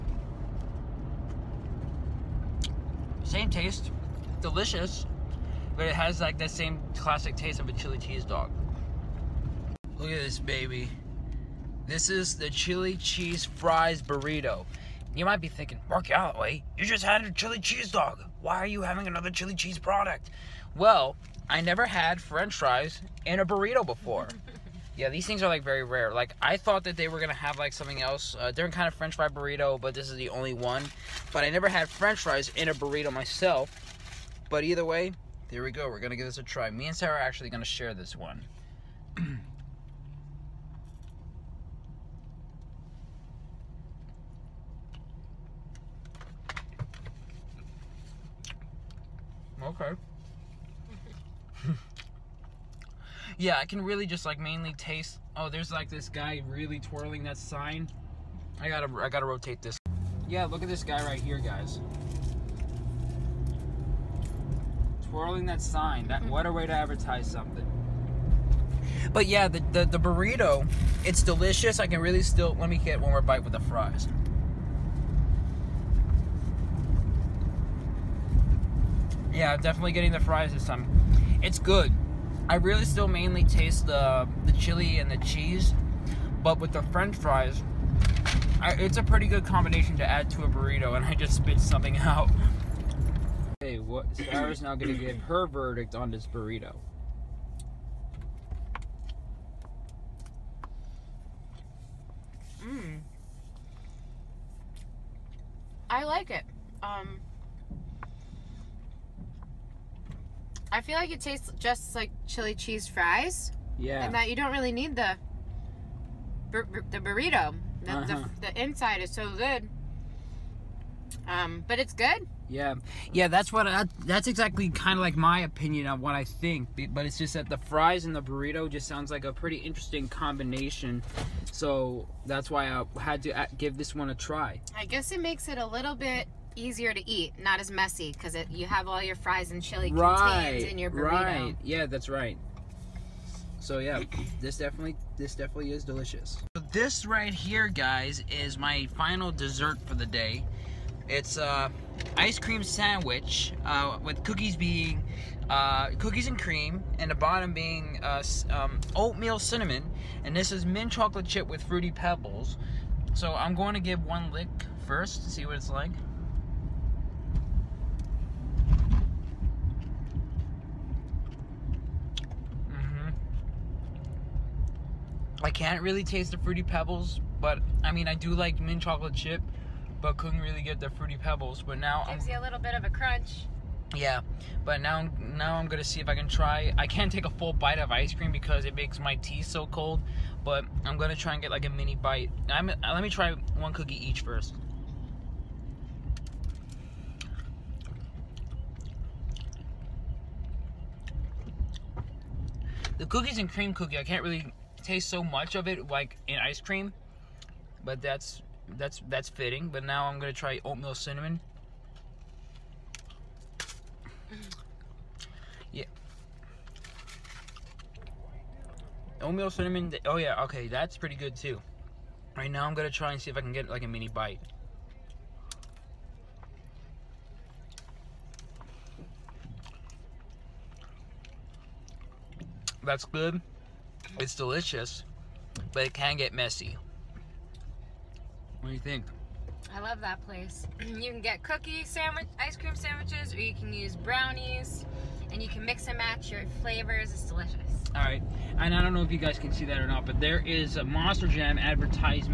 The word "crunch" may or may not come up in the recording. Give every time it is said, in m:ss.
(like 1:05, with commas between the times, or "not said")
3:02.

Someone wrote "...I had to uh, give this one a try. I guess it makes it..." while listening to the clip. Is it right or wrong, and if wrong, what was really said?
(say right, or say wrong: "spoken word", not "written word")
right.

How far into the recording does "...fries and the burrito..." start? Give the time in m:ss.
2:07.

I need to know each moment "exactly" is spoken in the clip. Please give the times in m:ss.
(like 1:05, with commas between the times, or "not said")
2:04.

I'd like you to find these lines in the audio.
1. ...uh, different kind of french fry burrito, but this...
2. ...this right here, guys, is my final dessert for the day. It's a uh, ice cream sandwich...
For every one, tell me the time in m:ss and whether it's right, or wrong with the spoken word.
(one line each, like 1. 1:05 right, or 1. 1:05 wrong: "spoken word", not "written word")
1. 0:28 right
2. 2:26 right.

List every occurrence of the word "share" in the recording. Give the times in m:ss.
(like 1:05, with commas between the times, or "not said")
0:37.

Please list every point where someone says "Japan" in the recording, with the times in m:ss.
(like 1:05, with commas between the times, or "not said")
not said.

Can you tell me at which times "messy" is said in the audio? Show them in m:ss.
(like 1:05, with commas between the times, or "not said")
2:17, 3:56.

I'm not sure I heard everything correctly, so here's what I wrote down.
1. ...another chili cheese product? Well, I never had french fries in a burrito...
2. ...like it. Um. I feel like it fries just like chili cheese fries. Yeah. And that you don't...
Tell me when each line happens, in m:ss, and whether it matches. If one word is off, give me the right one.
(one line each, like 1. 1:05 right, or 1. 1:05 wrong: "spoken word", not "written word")
1. 0:19 right
2. 1:46 wrong: "tastes", not "fries".